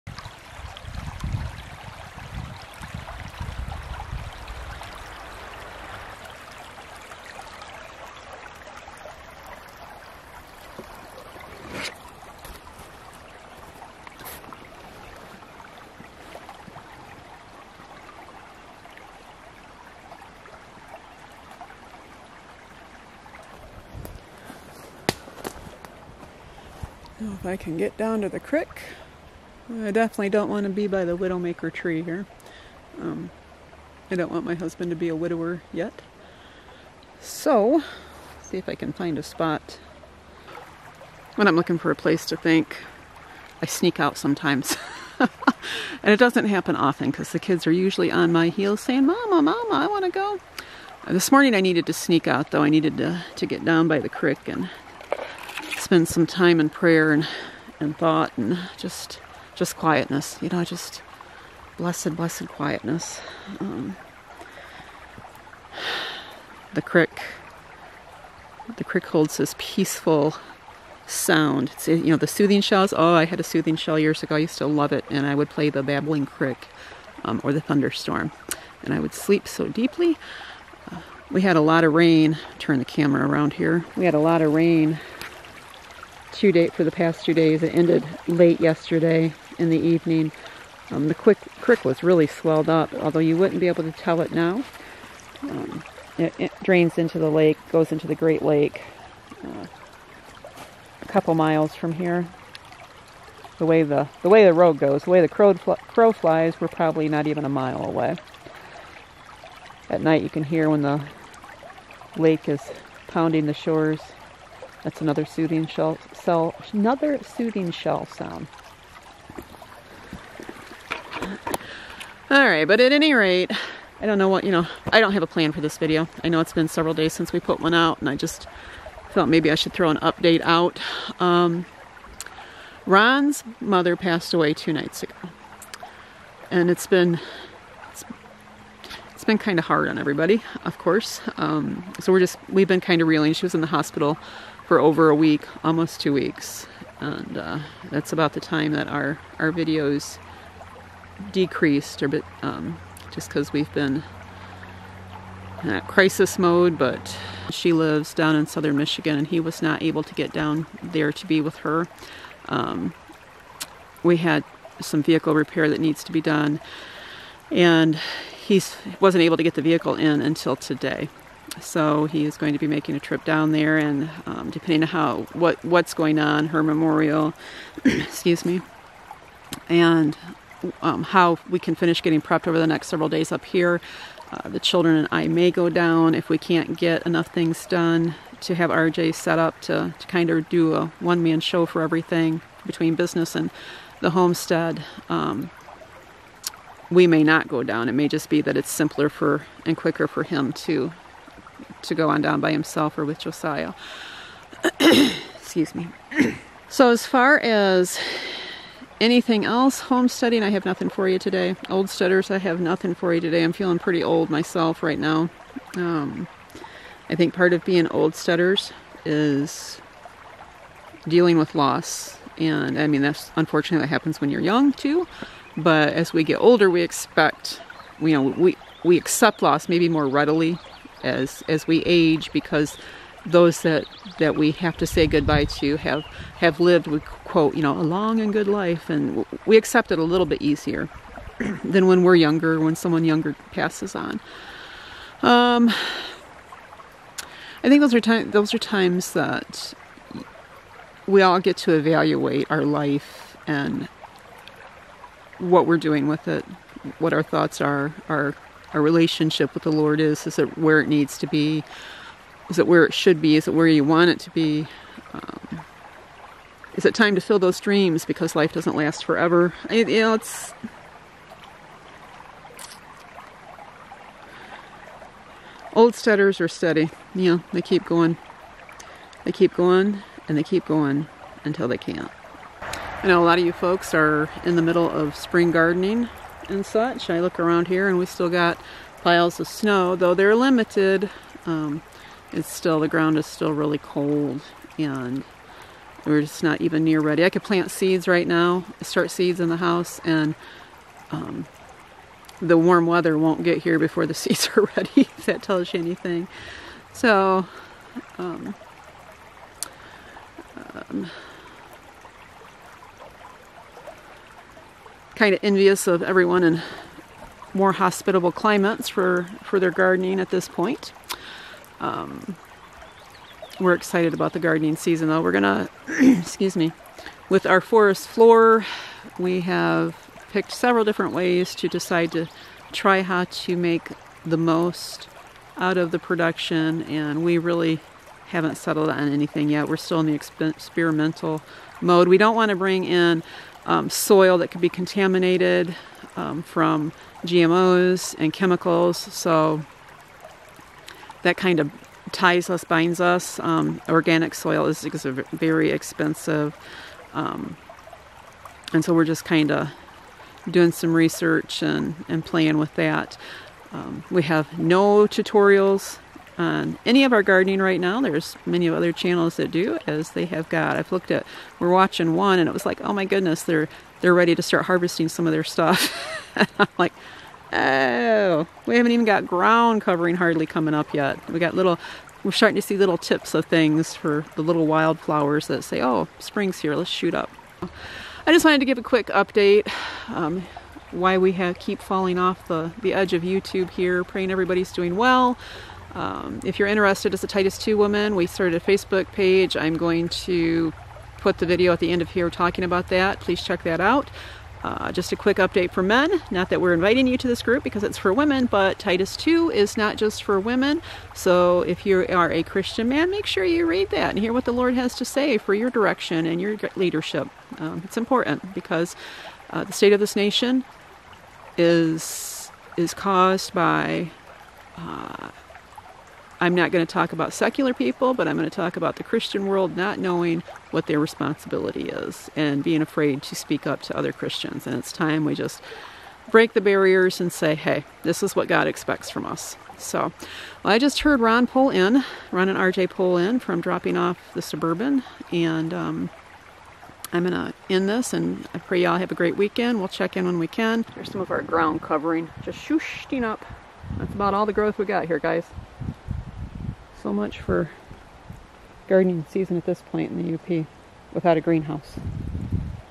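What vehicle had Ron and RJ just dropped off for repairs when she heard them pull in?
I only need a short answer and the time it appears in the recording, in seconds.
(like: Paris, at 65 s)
Suburban, at 444 s.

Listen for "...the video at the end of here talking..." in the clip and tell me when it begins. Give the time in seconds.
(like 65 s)
401 s.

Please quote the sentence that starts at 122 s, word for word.
All right, but at any rate, I don't know what, you know, I don't have a plan for this video.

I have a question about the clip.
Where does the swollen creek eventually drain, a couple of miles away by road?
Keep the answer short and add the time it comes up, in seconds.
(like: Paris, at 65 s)
Great Lake, at 98 s.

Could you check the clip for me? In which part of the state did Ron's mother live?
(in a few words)
Southern Michigan.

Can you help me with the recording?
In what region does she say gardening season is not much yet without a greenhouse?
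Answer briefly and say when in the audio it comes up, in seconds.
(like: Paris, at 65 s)
The UP, at 460 s.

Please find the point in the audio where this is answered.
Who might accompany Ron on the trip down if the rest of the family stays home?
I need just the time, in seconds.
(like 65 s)
203 s.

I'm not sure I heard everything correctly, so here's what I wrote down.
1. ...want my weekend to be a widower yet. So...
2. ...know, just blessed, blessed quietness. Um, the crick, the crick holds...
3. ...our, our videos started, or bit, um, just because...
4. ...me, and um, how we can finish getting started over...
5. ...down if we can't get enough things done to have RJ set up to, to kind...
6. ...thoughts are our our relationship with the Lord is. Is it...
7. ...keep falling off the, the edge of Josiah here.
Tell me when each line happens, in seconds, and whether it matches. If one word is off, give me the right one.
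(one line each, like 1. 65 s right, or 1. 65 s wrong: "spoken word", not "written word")
1. 34 s wrong: "husband", not "weekend"
2. 60 s right
3. 148 s wrong: "decreased", not "started"
4. 178 s wrong: "prepped", not "started"
5. 185 s right
6. 257 s right
7. 391 s wrong: "YouTube", not "Josiah".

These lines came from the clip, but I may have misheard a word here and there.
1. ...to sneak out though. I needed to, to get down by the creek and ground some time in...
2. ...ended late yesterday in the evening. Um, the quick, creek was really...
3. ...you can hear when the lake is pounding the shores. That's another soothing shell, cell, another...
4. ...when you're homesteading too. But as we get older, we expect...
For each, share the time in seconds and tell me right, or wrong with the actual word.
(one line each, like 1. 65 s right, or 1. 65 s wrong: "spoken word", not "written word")
1. 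51 s wrong: "spend", not "ground"
2. 87 s right
3. 110 s right
4. 224 s wrong: "young", not "homesteading".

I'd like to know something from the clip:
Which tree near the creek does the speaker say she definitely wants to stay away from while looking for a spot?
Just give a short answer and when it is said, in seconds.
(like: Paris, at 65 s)
Widowmaker, at 31 s.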